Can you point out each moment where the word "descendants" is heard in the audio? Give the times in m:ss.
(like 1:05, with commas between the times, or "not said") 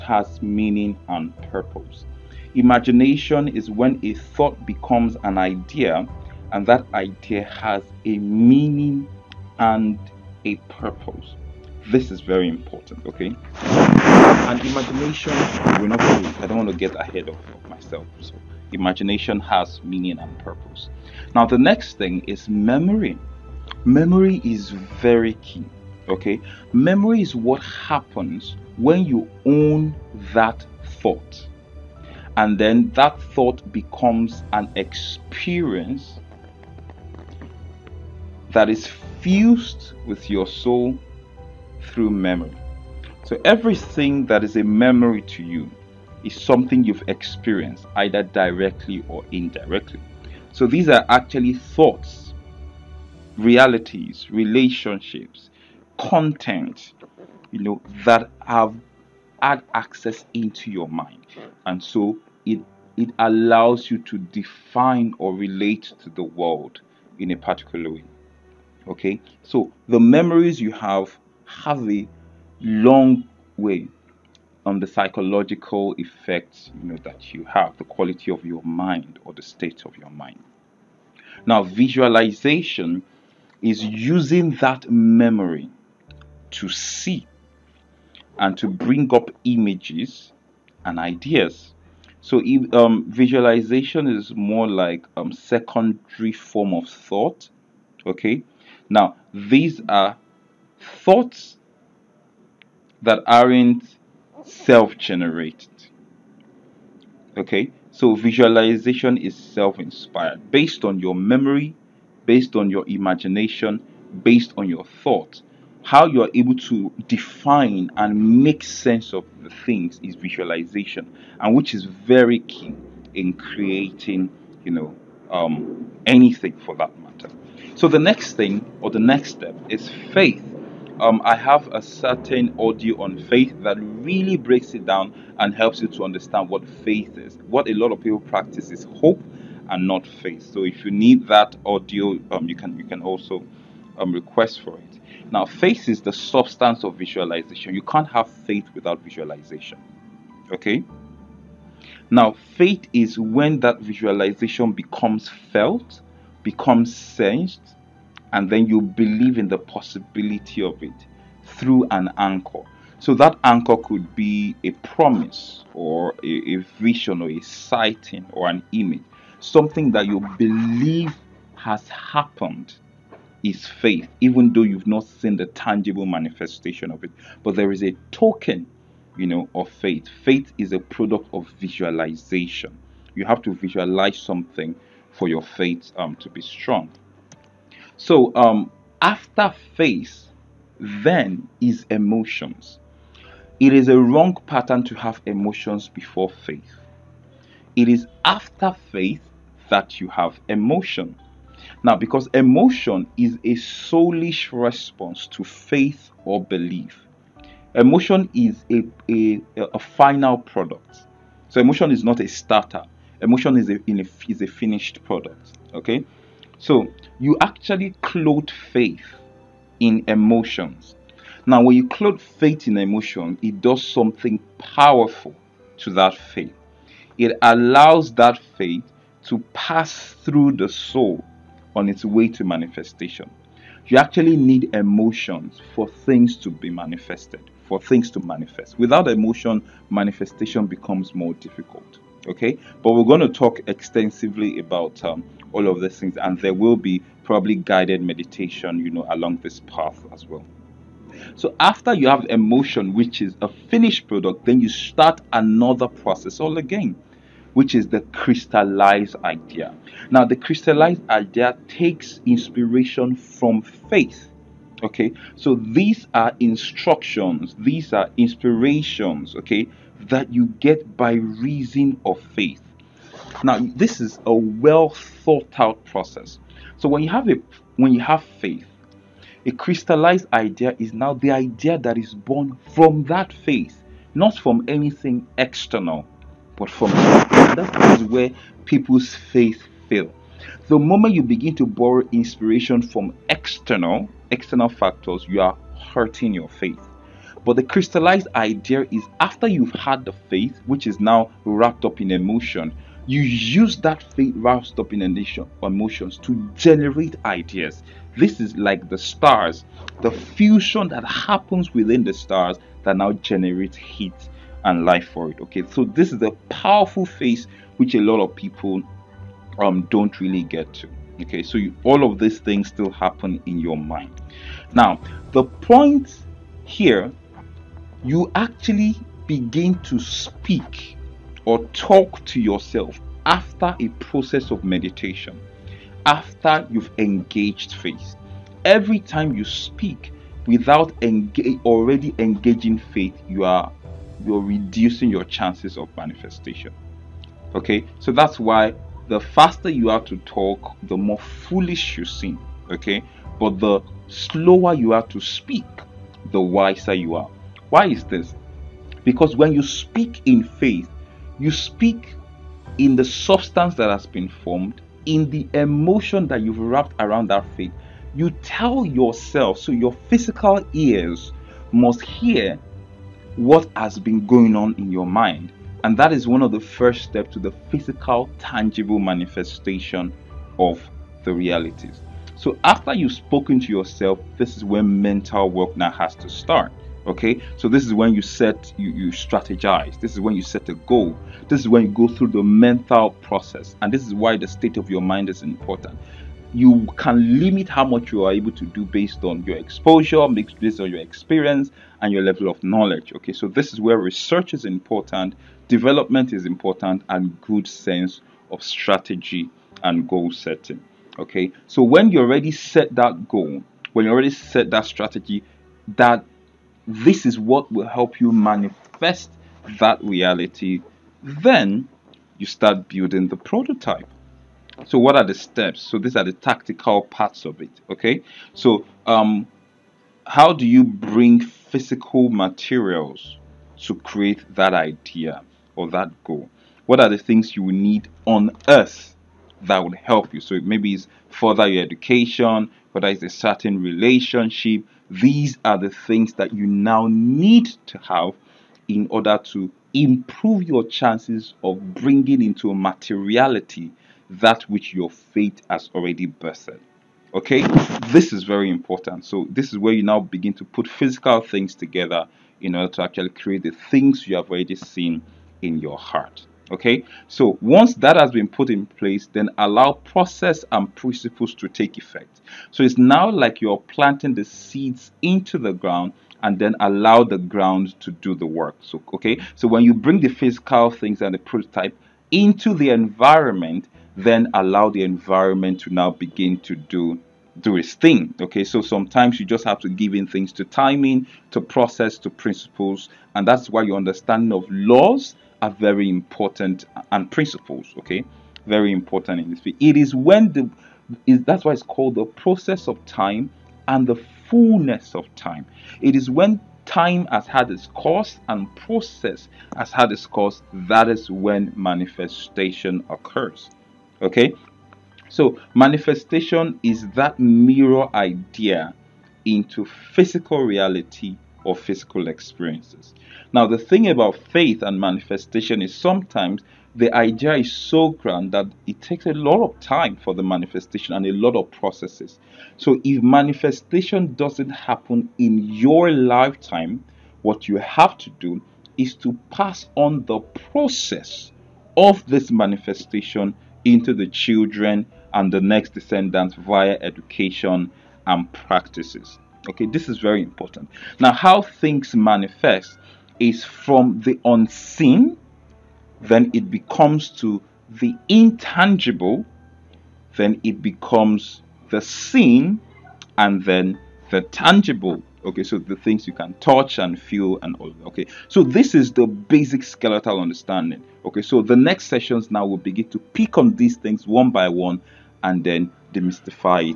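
9:05.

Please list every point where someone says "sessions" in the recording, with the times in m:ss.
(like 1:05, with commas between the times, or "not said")
9:32.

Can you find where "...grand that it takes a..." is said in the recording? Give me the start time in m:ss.
8:48.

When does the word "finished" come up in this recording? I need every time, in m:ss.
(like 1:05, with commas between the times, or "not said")
3:34, 4:13.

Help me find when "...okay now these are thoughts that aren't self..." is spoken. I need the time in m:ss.
1:38.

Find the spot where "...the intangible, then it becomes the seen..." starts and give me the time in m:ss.
9:17.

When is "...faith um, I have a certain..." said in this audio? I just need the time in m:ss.
2:10.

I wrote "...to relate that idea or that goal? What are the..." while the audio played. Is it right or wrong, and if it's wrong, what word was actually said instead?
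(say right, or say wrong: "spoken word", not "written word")
wrong: "create", not "relate".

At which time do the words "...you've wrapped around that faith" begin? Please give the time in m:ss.
6:06.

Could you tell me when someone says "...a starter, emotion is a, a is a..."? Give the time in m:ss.
3:32.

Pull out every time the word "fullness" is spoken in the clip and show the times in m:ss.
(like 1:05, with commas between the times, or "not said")
8:24.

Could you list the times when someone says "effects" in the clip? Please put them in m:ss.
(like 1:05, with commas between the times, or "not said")
1:15, 7:51.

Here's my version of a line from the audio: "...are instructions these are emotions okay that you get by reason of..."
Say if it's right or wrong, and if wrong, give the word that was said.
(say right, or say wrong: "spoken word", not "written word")
wrong: "inspirations", not "emotions".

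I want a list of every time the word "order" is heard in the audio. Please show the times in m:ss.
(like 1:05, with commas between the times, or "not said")
7:29, 7:42.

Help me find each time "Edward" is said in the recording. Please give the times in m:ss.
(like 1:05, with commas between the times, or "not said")
not said.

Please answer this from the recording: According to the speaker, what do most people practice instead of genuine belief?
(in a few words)
hope.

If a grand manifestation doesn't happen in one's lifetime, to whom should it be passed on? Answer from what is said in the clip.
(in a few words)
the children.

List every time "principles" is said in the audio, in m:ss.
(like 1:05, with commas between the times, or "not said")
7:50, 8:12, 8:17.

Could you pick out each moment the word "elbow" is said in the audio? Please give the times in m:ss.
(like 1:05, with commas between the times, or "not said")
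not said.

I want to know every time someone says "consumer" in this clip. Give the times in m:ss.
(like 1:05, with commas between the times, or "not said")
not said.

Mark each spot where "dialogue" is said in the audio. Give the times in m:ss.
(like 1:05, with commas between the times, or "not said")
not said.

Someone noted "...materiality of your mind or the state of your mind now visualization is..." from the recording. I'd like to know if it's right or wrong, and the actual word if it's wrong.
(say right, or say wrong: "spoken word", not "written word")
wrong: "quality", not "materiality".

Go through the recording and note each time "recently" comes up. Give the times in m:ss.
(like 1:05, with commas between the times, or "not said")
not said.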